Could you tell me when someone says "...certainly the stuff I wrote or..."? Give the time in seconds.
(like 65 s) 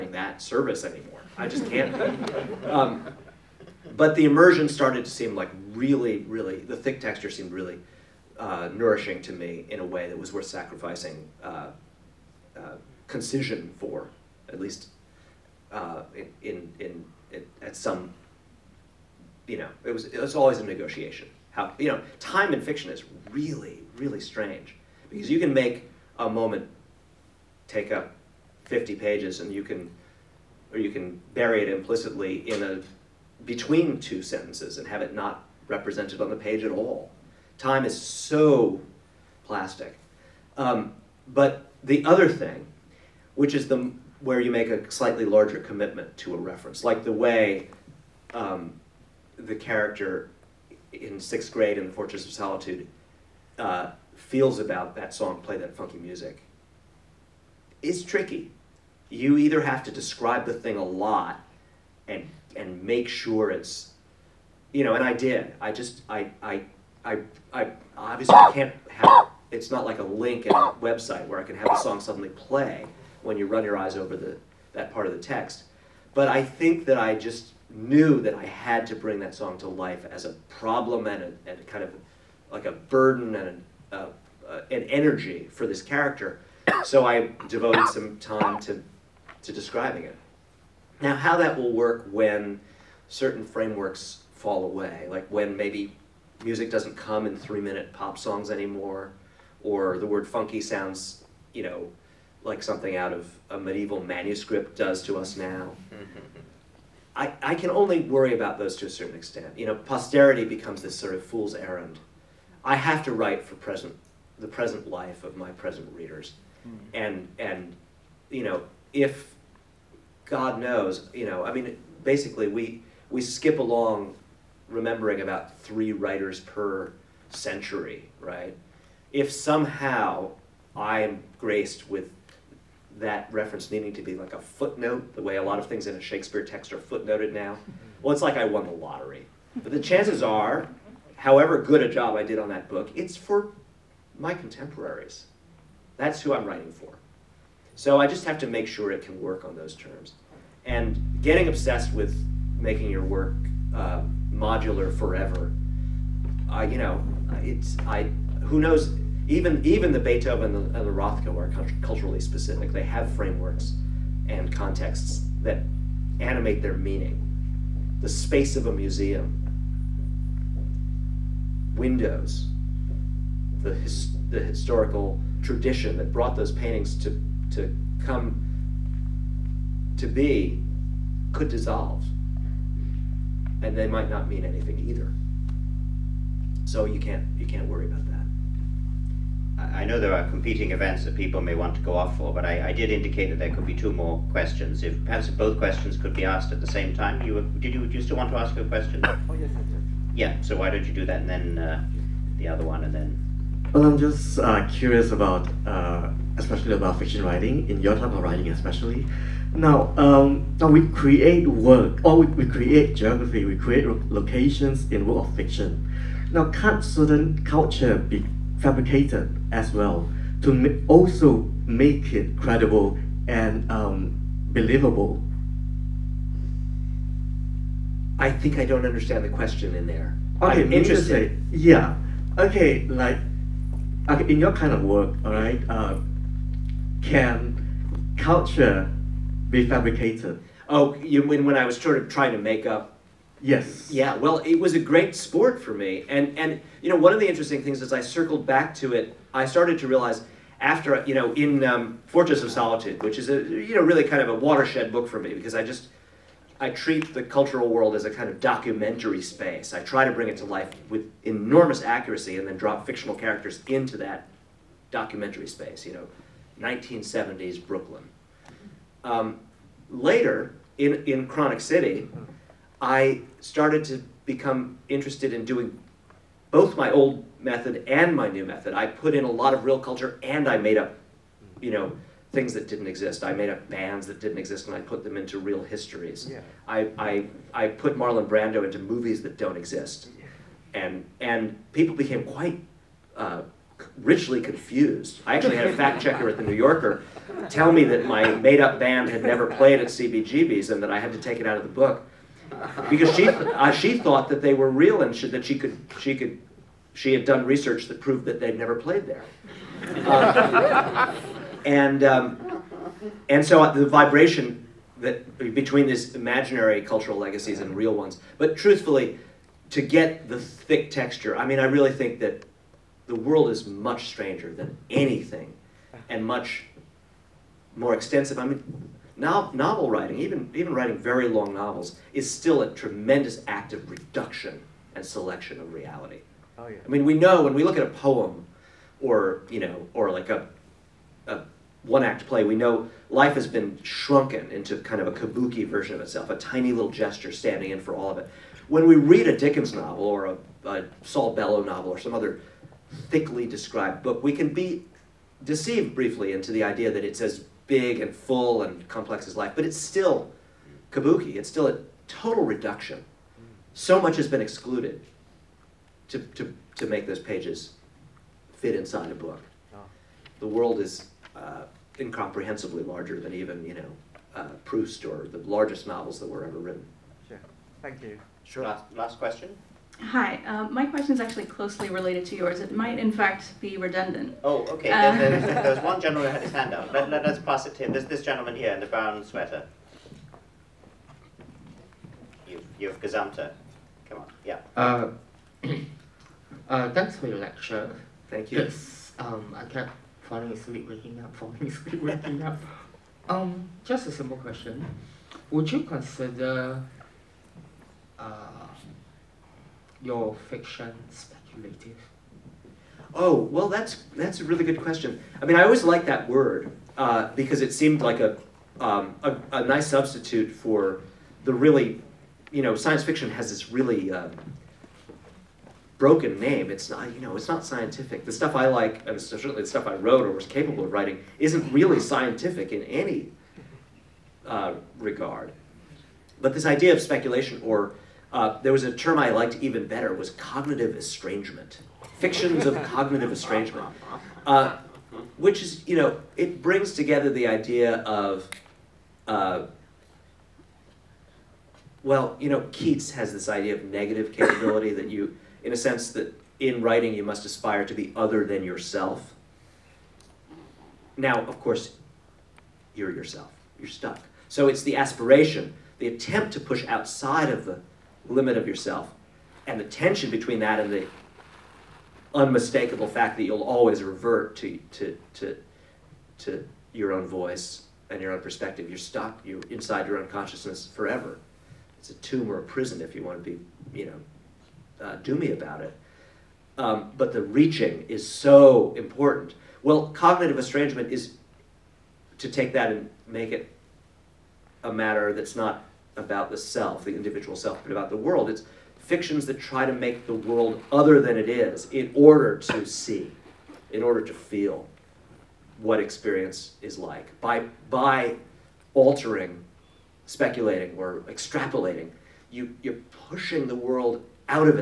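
429 s.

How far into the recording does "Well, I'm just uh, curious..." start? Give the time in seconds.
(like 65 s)
203 s.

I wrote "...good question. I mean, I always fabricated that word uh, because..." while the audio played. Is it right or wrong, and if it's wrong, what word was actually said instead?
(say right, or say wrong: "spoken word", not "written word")
wrong: "liked", not "fabricated".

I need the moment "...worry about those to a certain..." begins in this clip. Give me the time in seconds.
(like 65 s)
108 s.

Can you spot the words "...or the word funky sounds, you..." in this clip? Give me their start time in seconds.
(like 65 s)
99 s.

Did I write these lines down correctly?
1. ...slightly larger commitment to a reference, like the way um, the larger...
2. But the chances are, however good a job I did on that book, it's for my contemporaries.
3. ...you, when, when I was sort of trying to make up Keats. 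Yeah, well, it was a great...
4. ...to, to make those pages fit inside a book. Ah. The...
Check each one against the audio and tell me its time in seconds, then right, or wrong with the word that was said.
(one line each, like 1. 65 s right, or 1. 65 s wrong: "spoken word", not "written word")
1. 44 s wrong: "character", not "larger"
2. 139 s right
3. 240 s wrong: "Yes", not "Keats"
4. 366 s right.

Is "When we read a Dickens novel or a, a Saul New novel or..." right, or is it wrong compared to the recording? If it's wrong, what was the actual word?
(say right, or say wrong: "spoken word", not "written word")
wrong: "Bellow", not "New".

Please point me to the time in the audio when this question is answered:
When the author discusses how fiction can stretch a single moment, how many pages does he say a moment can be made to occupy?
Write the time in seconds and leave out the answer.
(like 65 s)
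28 s.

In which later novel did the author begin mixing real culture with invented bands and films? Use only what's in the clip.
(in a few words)
Chronic City.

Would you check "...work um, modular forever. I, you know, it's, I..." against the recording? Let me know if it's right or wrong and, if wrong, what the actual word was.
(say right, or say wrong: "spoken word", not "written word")
right.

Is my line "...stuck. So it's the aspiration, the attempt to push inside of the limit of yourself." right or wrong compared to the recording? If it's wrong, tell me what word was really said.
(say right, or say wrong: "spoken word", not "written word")
wrong: "outside", not "inside".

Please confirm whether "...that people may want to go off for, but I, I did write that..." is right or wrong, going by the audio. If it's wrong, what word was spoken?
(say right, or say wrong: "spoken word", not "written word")
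wrong: "indicate", not "write".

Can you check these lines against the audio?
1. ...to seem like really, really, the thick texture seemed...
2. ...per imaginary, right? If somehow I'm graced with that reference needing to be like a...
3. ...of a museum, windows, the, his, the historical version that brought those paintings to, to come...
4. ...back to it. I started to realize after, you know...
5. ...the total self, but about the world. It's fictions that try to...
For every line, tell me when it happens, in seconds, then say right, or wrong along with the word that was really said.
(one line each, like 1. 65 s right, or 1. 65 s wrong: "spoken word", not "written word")
1. 5 s right
2. 126 s wrong: "century", not "imaginary"
3. 168 s wrong: "tradition", not "version"
4. 248 s right
5. 497 s wrong: "individual", not "total".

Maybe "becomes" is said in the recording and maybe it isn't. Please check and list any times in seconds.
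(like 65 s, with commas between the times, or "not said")
110 s, 274 s.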